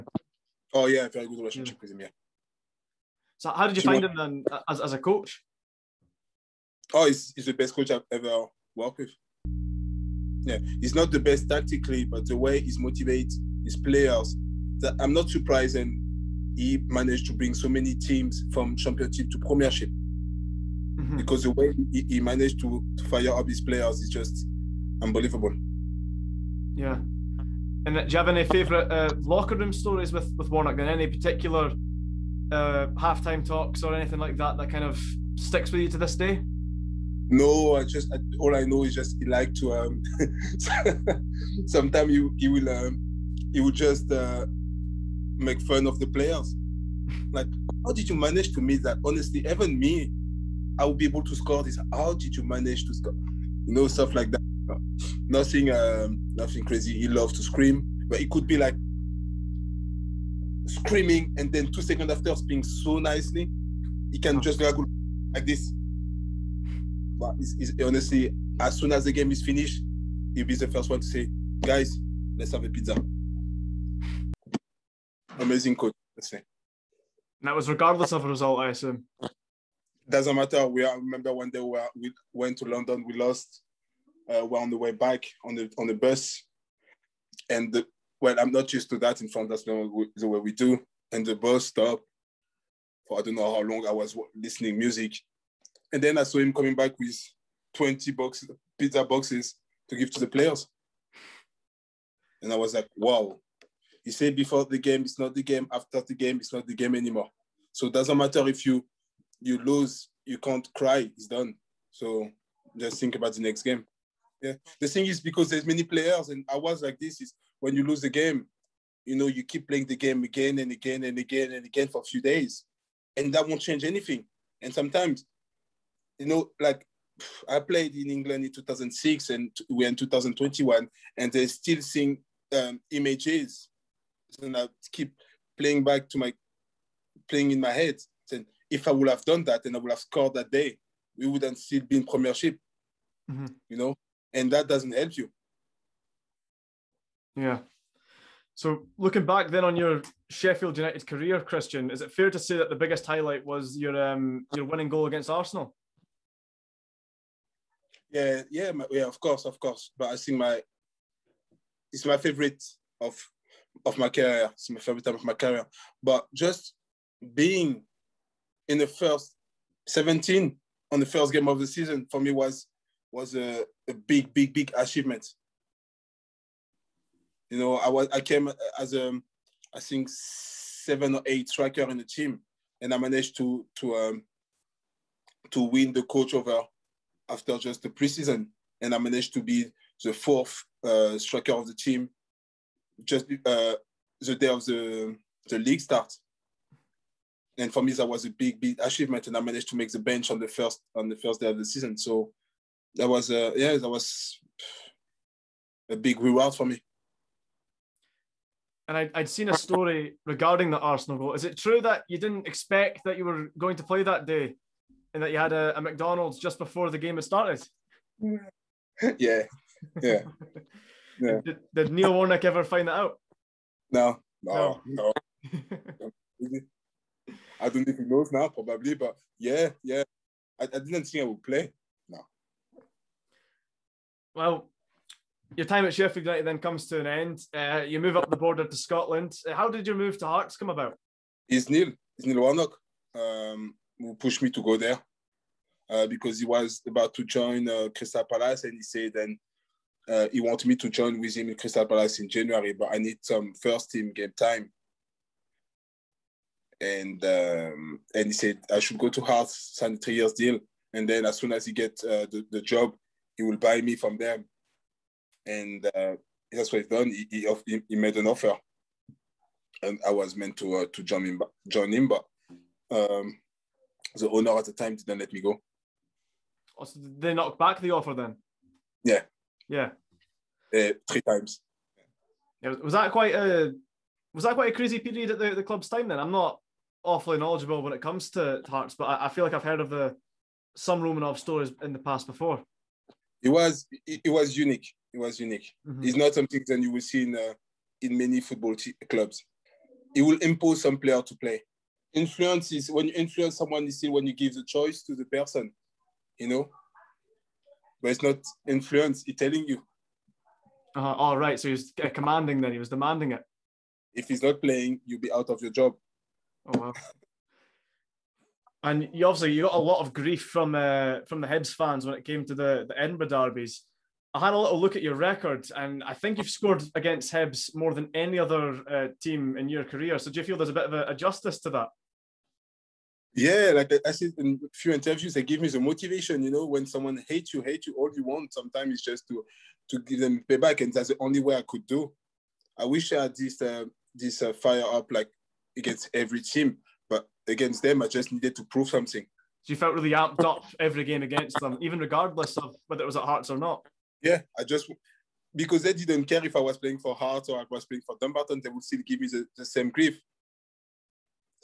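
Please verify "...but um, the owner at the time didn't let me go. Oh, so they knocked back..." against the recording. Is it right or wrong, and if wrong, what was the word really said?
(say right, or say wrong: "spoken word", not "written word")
right.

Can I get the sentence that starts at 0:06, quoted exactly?
Oh, he's, he's the best coach I've ever worked with.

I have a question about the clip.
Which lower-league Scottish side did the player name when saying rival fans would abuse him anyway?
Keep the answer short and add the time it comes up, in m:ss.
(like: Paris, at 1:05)
Dumbarton, at 5:58.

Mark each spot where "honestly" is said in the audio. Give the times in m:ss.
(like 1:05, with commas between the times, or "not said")
0:49, 1:07.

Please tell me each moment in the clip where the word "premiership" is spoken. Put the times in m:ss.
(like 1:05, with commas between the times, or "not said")
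0:19, 2:22.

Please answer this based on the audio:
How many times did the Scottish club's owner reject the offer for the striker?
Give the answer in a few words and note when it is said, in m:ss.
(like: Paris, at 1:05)
3, at 4:41.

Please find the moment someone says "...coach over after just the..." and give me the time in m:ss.
3:06.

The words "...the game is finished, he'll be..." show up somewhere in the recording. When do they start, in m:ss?
1:09.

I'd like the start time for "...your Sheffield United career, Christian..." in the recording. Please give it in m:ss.
2:29.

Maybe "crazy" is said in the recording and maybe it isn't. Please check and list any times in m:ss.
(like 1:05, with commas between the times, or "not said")
0:56, 4:44.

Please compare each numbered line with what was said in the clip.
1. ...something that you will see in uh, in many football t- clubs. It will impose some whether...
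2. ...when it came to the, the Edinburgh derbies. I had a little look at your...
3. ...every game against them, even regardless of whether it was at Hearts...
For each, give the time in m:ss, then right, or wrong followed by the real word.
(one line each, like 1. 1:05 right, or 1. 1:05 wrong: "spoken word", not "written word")
1. 4:56 wrong: "player", not "whether"
2. 5:22 right
3. 5:50 right.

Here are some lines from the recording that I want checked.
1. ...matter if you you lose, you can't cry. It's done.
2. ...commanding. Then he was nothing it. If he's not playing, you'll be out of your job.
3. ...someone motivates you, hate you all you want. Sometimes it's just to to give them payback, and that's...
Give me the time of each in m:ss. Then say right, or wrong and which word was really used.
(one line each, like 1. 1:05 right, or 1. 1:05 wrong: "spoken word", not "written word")
1. 1:48 right
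2. 5:12 wrong: "demanding", not "nothing"
3. 5:36 wrong: "hates", not "motivates".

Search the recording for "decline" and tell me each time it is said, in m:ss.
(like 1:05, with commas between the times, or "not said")
not said.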